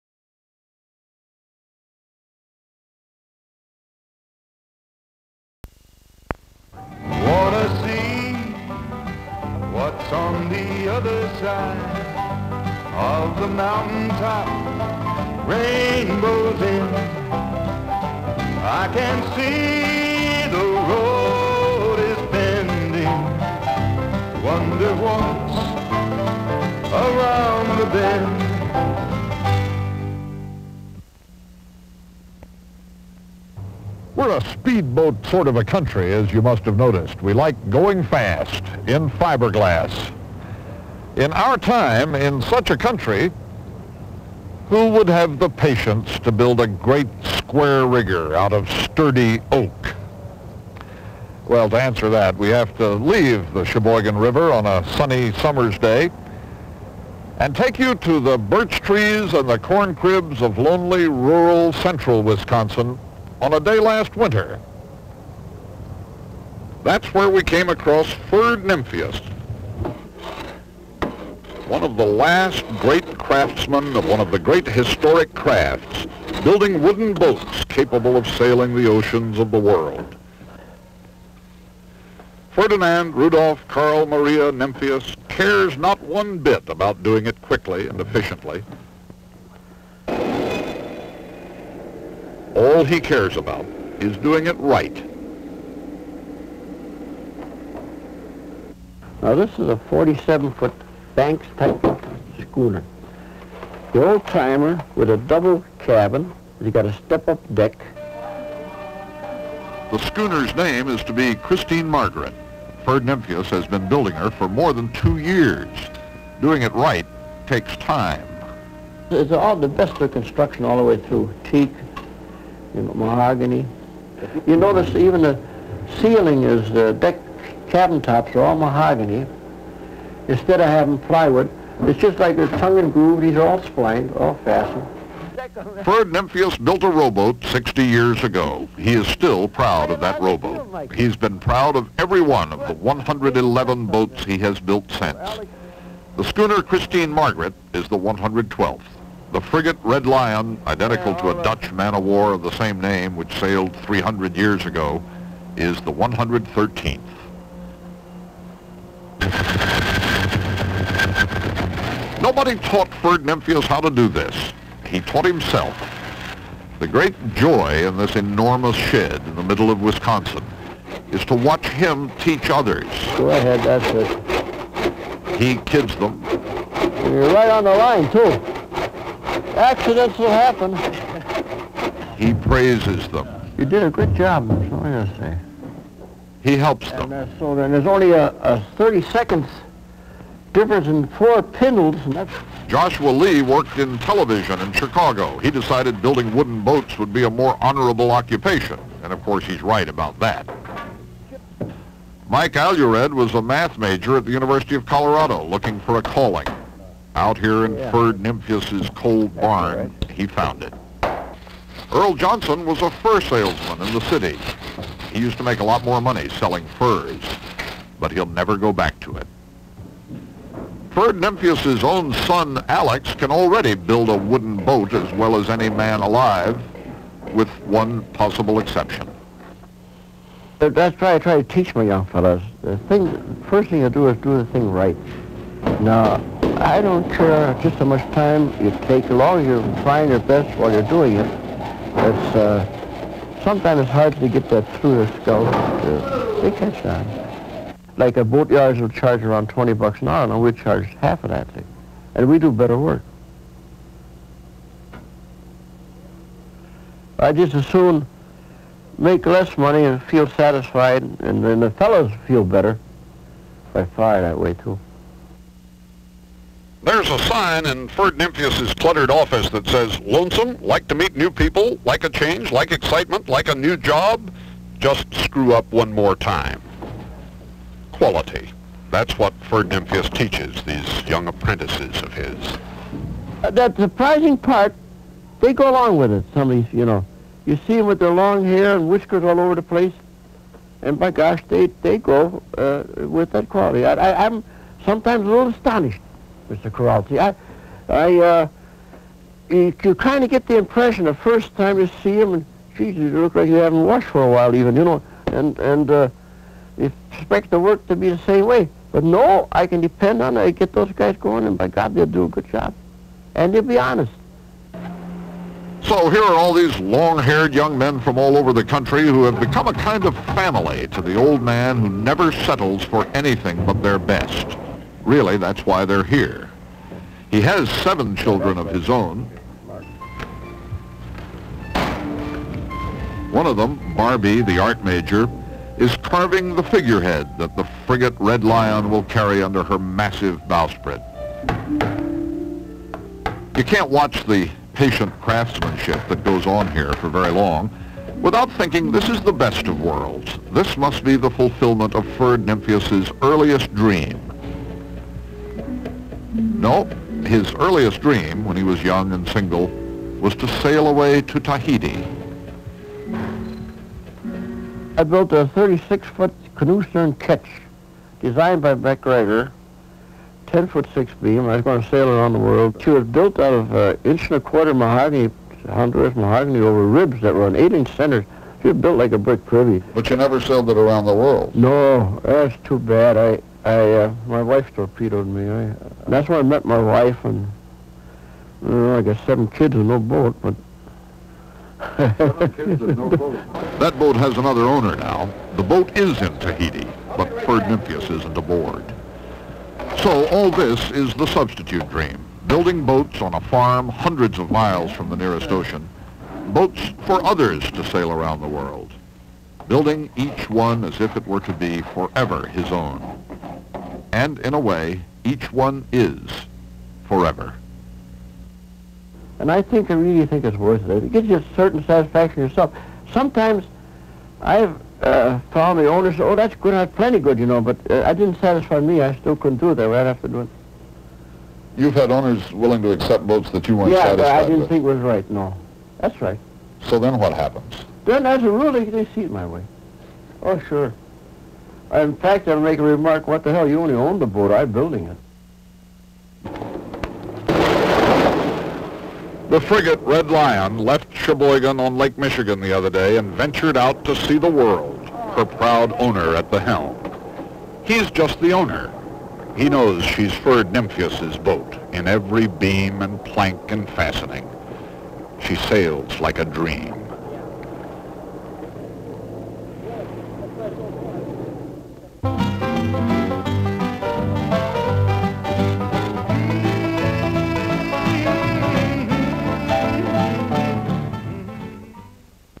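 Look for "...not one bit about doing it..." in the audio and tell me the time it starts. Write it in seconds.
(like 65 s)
85 s.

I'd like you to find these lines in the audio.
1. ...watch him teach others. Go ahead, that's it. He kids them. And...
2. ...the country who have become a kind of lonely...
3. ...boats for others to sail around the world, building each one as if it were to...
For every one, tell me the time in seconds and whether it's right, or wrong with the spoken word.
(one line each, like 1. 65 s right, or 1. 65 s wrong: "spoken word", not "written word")
1. 171 s right
2. 318 s wrong: "family", not "lonely"
3. 406 s right.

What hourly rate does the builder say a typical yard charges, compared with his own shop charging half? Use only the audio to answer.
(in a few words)
$20.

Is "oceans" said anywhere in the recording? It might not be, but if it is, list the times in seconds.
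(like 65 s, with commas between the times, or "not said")
78 s, 405 s.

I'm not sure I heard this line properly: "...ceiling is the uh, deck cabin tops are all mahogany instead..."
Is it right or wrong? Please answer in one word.
right.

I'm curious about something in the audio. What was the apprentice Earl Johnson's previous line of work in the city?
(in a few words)
Fur salesman.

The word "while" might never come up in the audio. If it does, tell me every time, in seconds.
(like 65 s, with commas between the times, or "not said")
240 s, 304 s.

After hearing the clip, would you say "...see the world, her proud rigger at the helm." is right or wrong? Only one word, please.
wrong.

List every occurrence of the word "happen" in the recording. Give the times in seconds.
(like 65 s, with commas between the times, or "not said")
180 s, 437 s.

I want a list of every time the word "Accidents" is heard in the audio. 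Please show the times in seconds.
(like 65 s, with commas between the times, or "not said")
179 s.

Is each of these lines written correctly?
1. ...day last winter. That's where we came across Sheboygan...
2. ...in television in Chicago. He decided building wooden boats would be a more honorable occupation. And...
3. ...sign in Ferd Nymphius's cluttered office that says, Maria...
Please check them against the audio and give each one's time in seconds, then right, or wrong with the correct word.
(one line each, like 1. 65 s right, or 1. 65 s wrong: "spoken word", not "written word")
1. 63 s wrong: "Ferd", not "Sheboygan"
2. 193 s right
3. 267 s wrong: "Lonesome", not "Maria".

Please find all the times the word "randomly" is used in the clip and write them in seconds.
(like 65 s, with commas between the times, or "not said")
not said.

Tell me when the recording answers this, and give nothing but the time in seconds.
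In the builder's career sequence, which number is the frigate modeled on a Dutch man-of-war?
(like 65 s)
155 s.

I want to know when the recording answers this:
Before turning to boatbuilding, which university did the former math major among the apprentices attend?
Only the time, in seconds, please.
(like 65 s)
204 s.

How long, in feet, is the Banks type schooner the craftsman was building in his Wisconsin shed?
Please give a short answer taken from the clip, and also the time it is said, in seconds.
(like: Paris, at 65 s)
47, at 99 s.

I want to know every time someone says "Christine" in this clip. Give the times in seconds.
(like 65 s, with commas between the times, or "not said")
111 s, 146 s.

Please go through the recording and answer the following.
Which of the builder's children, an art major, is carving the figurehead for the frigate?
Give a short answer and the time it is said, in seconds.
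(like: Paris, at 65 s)
Barbie, at 333 s.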